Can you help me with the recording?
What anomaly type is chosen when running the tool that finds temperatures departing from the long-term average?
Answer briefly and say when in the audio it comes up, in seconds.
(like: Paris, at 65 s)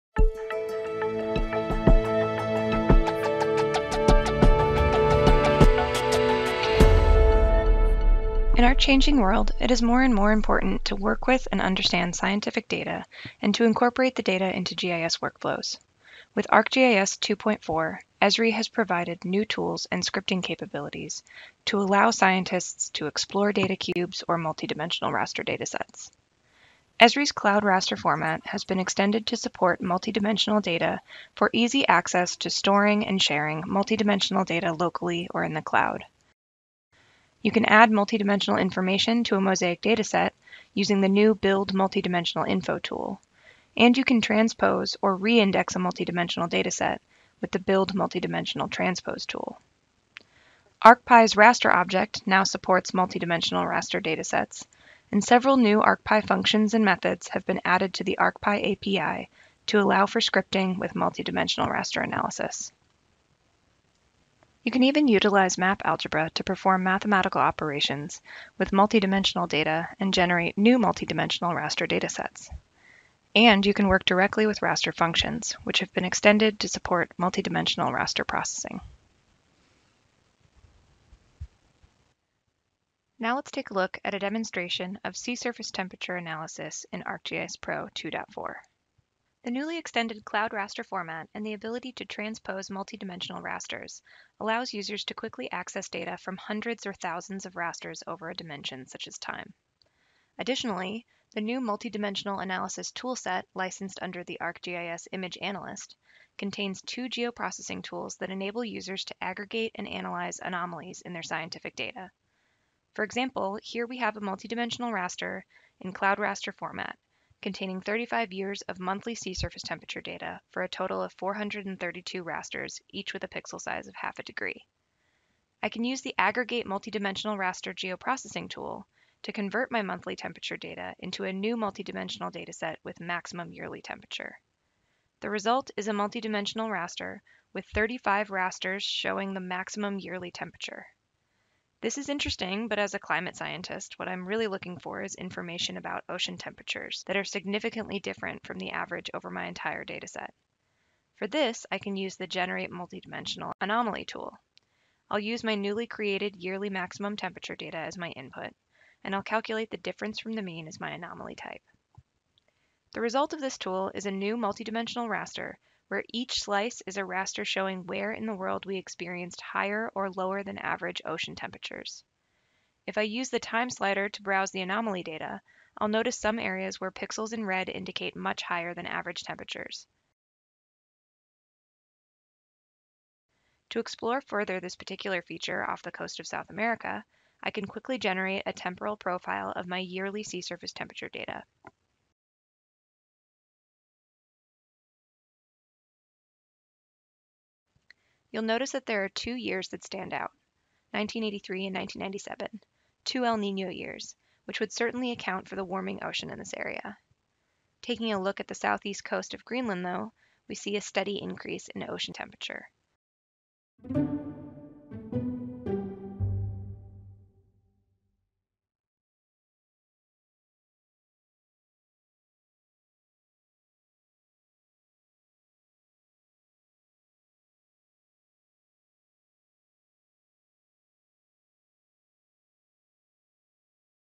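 difference from the mean, at 159 s.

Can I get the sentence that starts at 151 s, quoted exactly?
For this, I can use the Generate Multidimensional Anomaly tool.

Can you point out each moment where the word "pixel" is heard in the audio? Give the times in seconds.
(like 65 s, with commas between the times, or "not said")
123 s, 176 s.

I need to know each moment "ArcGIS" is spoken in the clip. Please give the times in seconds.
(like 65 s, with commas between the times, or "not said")
16 s, 87 s, 104 s.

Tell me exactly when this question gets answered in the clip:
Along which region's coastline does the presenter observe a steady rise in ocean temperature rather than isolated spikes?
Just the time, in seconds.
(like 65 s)
208 s.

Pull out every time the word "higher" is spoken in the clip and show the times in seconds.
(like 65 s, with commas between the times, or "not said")
169 s, 178 s.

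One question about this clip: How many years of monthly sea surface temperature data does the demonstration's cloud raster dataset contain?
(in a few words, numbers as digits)
35.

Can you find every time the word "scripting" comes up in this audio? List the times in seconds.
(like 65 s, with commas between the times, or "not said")
20 s, 60 s.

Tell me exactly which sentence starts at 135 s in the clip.
The result is a multidimensional raster with 35 rasters showing the maximum yearly temperature.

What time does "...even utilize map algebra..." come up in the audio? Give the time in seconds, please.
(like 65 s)
64 s.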